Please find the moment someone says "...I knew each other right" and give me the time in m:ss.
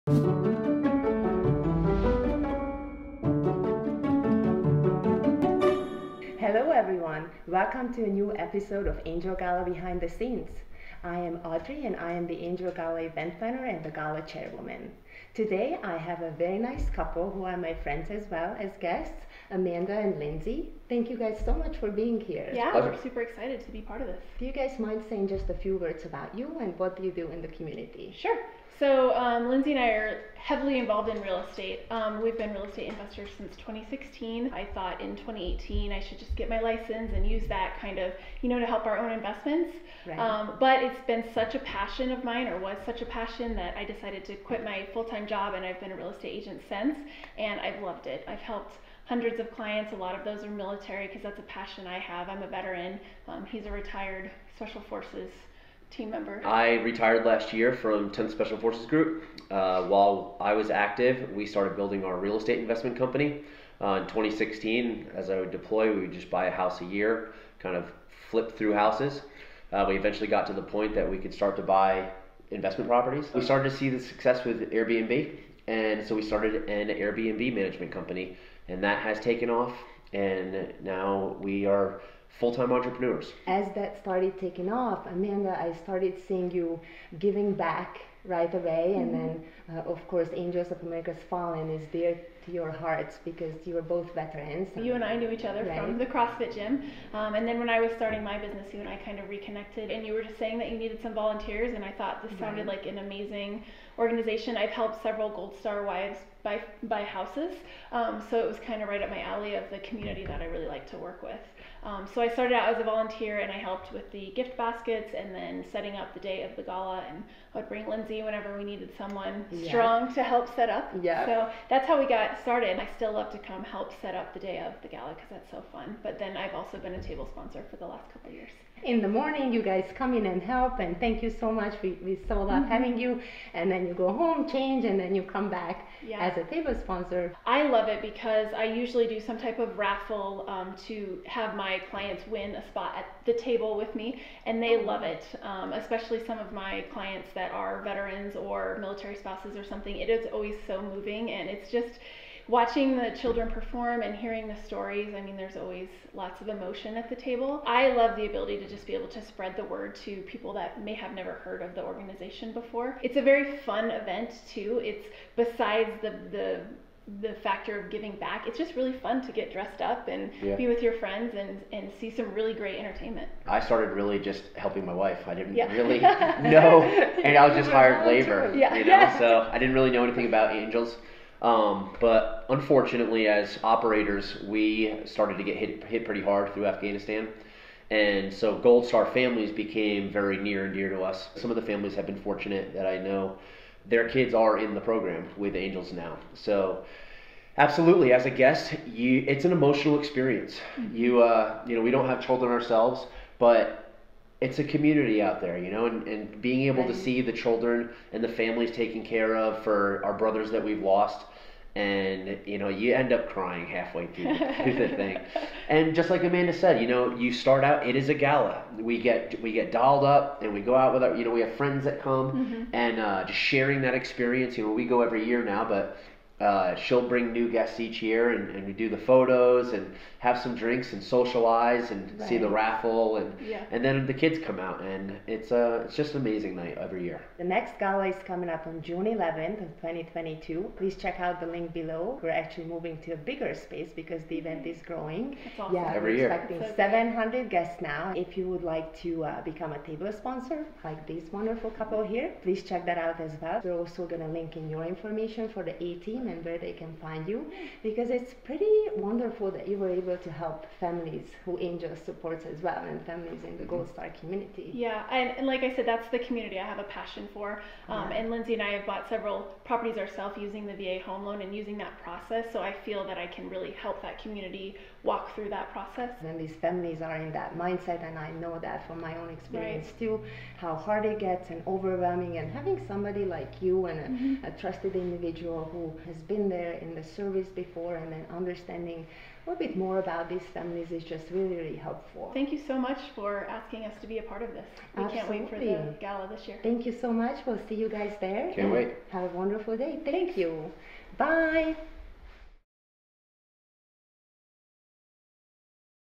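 1:35.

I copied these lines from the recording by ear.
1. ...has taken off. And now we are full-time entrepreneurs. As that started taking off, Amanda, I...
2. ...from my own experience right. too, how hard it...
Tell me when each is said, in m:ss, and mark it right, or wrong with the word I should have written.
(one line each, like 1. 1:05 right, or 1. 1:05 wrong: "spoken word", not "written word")
1. 1:18 right
2. 4:38 right.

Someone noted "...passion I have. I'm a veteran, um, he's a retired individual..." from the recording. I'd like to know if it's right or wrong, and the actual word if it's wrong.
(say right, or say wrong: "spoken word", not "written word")
wrong: "special", not "individual".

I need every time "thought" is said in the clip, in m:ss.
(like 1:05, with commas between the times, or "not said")
0:34, 1:41.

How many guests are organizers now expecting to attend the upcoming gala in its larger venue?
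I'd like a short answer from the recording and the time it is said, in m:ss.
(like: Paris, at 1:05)
700, at 4:06.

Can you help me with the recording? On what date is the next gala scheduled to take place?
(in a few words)
June 11th, 2022.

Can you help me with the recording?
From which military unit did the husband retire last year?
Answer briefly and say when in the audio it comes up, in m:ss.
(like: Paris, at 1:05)
10th Special Forces Group, at 0:58.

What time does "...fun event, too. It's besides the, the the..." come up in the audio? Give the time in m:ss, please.
2:43.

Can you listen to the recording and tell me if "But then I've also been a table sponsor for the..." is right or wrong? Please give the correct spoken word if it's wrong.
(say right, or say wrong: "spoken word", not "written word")
right.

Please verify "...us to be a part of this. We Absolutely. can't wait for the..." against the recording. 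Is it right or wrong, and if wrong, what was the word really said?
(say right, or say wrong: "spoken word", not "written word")
right.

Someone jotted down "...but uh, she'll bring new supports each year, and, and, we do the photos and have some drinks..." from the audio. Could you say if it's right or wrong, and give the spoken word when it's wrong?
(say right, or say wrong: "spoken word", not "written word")
wrong: "guests", not "supports".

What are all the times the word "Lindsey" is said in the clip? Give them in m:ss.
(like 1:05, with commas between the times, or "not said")
0:20, 0:29, 1:57, 4:28.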